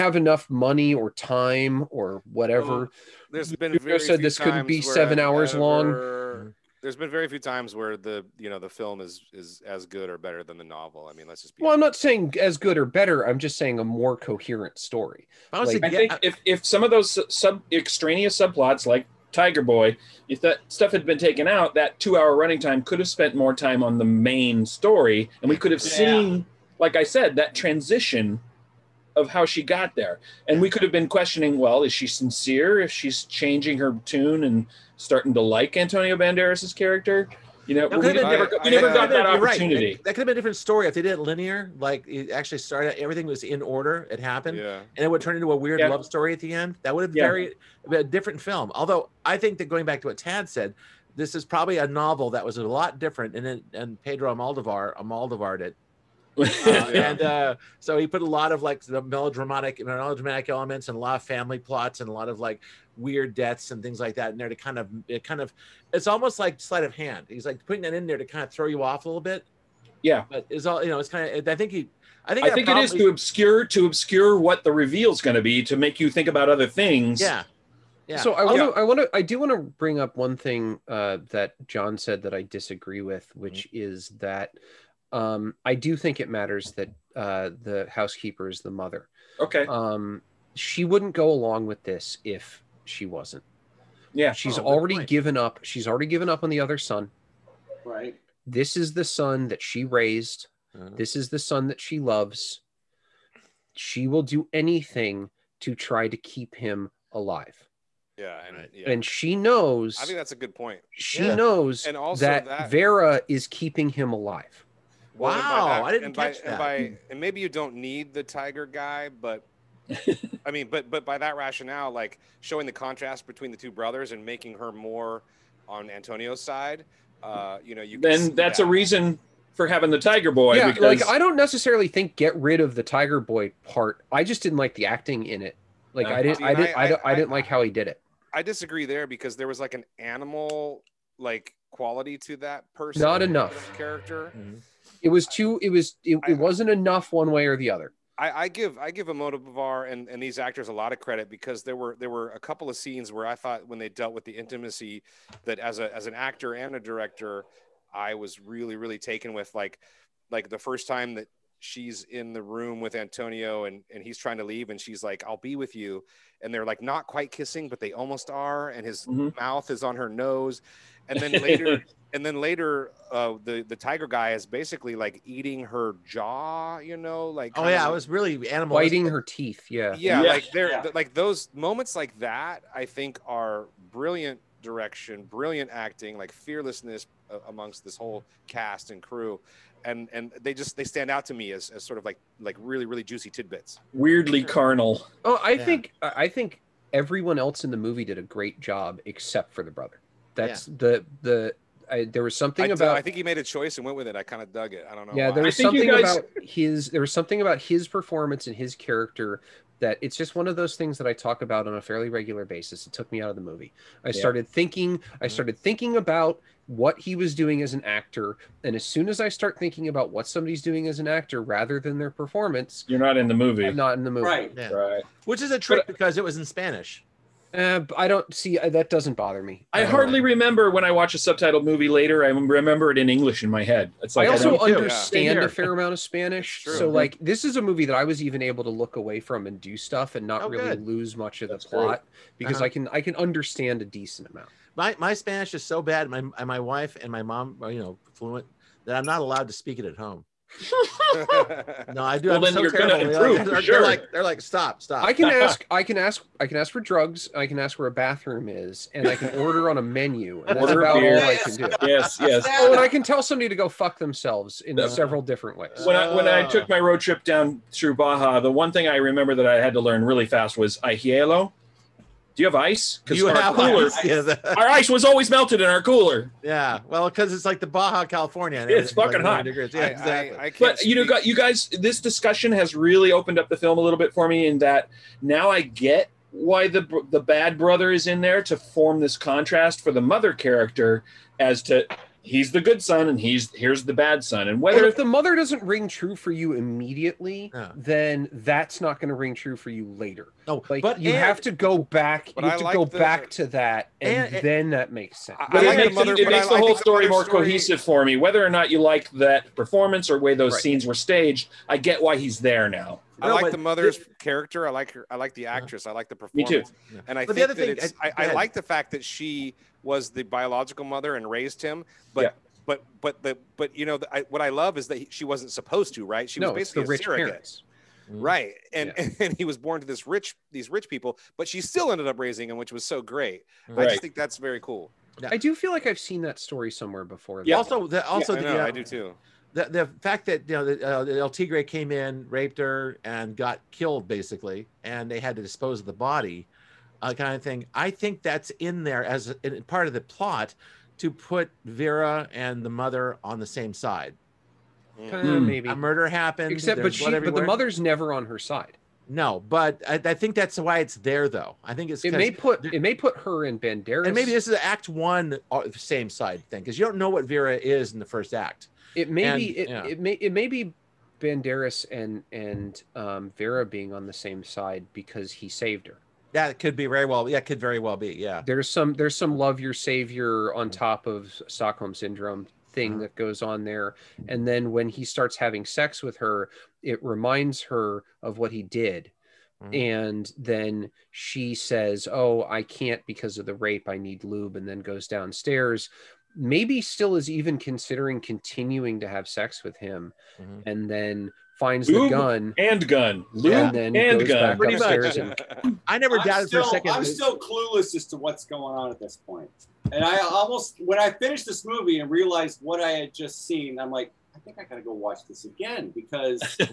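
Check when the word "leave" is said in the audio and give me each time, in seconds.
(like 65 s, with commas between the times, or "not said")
164 s.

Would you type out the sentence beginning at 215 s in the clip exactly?
started thinking about what he was doing as an actor.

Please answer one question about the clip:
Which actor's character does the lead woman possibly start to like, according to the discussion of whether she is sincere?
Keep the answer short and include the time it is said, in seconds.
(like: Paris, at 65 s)
Antonio Banderas, at 35 s.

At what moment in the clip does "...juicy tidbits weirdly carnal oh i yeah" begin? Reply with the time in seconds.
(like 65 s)
193 s.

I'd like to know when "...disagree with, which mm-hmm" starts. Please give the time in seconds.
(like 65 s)
82 s.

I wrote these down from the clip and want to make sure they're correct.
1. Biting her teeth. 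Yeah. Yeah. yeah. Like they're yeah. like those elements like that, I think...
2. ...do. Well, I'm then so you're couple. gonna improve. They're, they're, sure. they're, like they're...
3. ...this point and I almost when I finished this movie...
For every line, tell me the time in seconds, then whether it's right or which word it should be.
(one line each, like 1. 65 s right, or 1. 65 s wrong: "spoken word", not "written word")
1. 178 s wrong: "moments", not "elements"
2. 252 s wrong: "terrible", not "couple"
3. 408 s right.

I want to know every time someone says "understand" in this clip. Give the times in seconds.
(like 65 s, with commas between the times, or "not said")
234 s, 243 s.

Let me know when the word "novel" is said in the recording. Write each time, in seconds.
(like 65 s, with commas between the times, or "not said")
10 s, 51 s.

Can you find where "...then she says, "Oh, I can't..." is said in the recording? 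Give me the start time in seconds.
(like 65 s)
390 s.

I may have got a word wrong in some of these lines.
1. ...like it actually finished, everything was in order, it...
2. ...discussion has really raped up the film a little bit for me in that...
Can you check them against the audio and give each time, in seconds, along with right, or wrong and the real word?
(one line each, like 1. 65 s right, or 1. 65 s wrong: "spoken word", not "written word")
1. 41 s wrong: "started", not "finished"
2. 281 s wrong: "opened", not "raped".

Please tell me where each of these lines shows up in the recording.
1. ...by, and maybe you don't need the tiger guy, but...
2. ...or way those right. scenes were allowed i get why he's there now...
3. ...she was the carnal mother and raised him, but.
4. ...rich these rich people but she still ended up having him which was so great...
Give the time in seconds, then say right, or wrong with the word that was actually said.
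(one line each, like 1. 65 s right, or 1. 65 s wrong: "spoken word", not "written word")
1. 116 s right
2. 310 s wrong: "staged", not "allowed"
3. 319 s wrong: "biological", not "carnal"
4. 330 s wrong: "raising", not "having".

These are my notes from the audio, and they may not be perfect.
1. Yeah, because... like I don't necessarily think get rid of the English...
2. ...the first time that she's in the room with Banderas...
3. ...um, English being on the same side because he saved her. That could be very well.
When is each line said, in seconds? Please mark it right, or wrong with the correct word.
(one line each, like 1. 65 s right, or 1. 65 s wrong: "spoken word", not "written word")
1. 130 s wrong: "Tiger", not "English"
2. 160 s wrong: "Antonio", not "Banderas"
3. 372 s wrong: "Vera", not "English".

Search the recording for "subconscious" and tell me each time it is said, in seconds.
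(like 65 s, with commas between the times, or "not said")
not said.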